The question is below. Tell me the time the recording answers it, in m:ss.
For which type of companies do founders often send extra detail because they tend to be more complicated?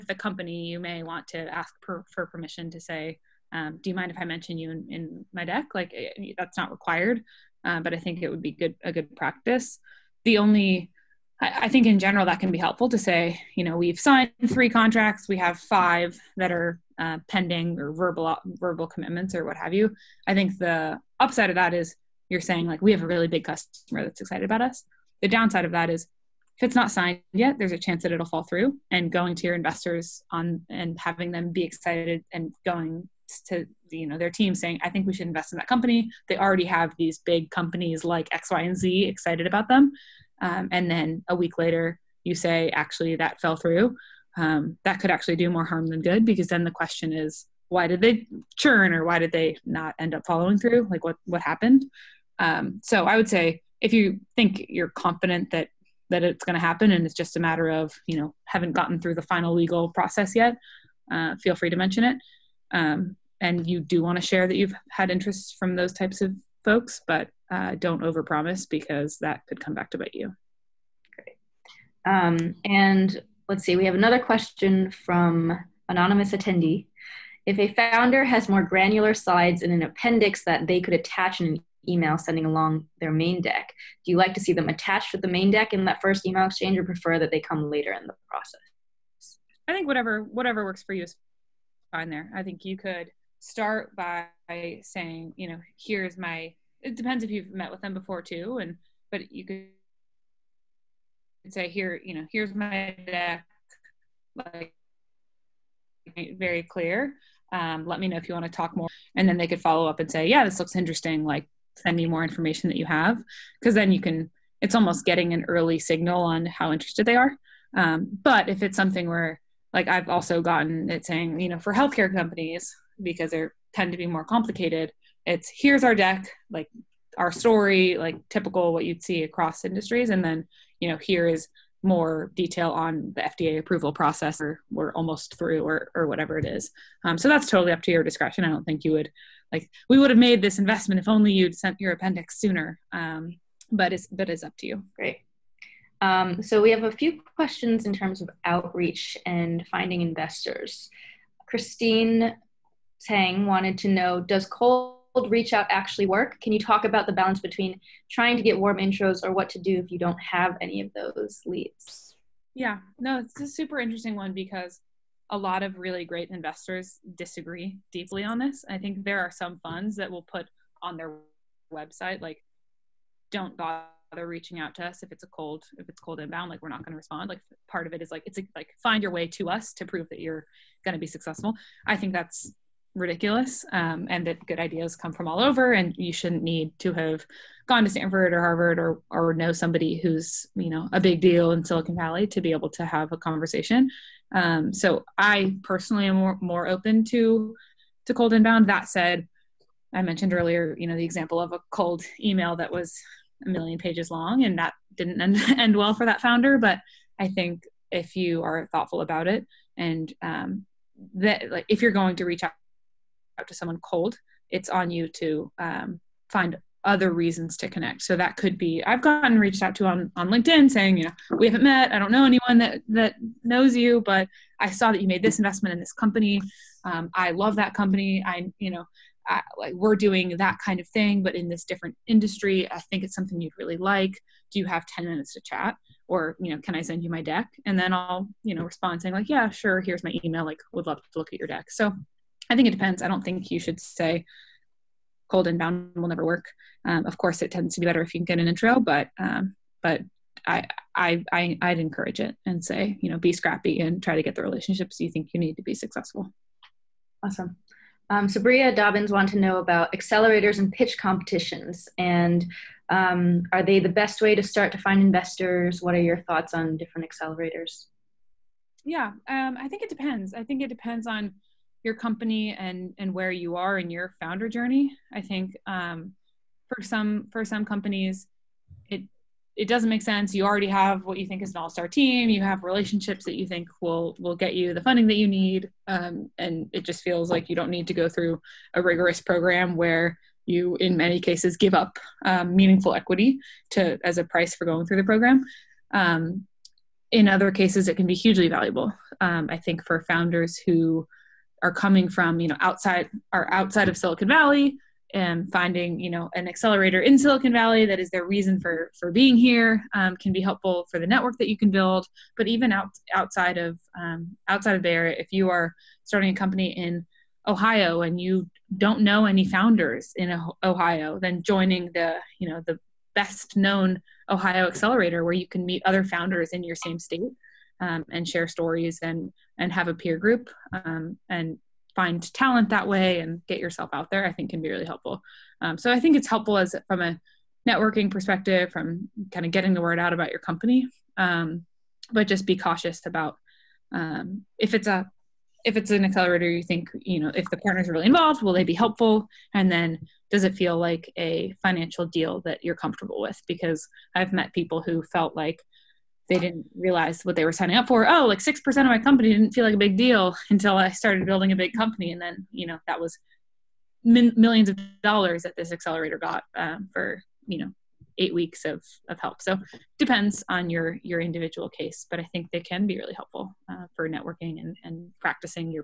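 2:01.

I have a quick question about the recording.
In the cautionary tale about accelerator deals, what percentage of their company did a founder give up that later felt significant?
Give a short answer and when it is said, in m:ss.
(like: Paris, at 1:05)
6%, at 5:58.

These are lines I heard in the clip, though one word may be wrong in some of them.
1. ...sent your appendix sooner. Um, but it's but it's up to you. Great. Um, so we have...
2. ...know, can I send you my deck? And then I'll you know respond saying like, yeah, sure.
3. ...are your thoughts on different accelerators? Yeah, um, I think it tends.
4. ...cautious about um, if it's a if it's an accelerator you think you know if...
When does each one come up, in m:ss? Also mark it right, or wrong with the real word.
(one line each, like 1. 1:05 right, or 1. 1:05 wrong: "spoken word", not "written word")
1. 2:21 right
2. 3:56 right
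3. 4:25 wrong: "depends", not "tends"
4. 5:42 right.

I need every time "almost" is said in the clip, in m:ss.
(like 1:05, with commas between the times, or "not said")
1:54, 2:14.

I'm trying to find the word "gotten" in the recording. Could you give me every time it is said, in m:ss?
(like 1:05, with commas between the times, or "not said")
0:58, 2:00, 3:39.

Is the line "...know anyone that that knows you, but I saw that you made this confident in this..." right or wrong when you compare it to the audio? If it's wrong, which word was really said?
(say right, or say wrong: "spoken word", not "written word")
wrong: "investment", not "confident".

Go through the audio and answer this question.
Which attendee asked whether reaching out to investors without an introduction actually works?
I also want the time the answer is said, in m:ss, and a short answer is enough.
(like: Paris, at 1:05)
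Christine Tang, at 2:31.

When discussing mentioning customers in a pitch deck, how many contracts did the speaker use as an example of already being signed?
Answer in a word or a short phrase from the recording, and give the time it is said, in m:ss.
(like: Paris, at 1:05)
3, at 0:14.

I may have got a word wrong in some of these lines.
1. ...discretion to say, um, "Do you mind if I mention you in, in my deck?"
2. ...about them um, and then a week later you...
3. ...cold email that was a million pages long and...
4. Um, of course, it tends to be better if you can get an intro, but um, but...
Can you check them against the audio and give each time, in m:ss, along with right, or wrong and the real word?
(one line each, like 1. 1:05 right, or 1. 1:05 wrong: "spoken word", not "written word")
1. 0:02 wrong: "permission", not "discretion"
2. 0:39 right
3. 3:21 right
4. 4:06 right.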